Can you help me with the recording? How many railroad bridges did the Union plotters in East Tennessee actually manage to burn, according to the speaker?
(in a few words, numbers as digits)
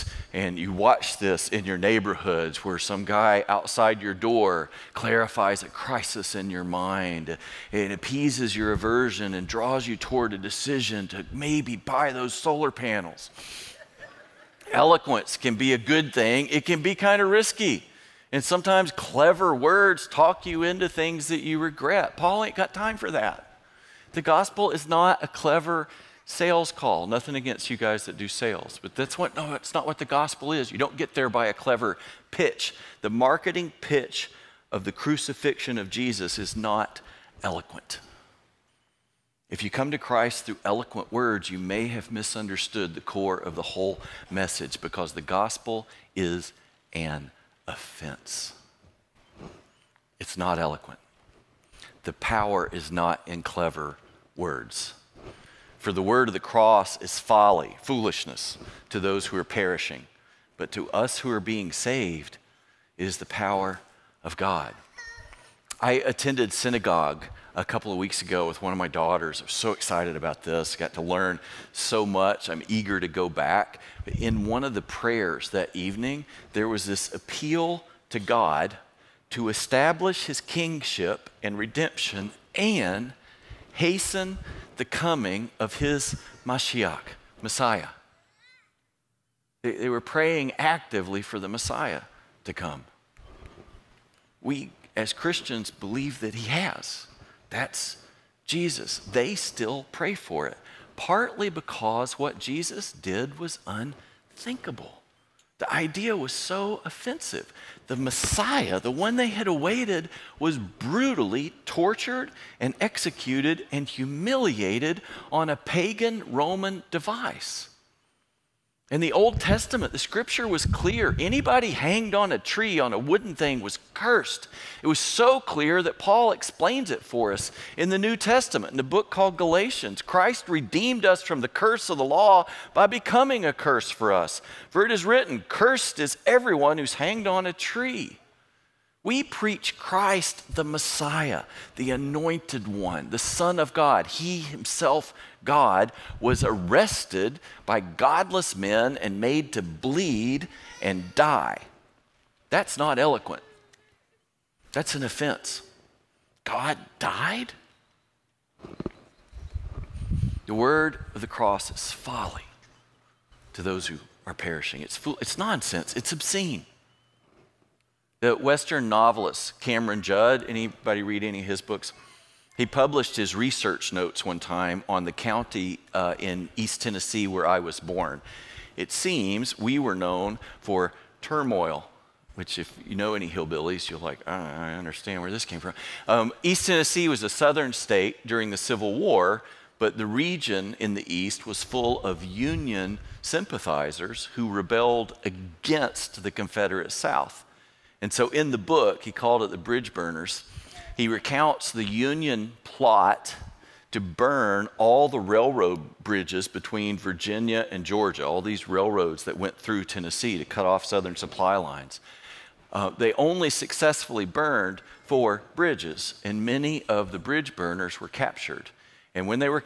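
4.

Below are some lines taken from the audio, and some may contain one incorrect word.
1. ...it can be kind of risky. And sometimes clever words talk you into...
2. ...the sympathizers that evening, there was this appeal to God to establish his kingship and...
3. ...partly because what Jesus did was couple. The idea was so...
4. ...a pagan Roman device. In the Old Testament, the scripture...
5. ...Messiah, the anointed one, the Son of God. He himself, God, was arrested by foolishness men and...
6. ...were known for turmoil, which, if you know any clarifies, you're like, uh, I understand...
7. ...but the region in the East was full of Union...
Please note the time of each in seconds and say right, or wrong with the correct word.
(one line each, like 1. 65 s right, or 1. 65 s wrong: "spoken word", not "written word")
1. 16 s right
2. 74 s wrong: "prayers", not "sympathizers"
3. 100 s wrong: "unthinkable", not "couple"
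4. 115 s right
5. 140 s wrong: "godless", not "foolishness"
6. 179 s wrong: "hillbillies", not "clarifies"
7. 189 s right.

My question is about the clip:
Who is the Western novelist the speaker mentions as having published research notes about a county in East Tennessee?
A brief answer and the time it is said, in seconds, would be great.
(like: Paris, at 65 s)
Cameron Judd, at 169 s.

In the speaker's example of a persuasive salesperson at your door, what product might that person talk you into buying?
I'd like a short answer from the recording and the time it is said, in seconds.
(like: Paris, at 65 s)
solar panels, at 12 s.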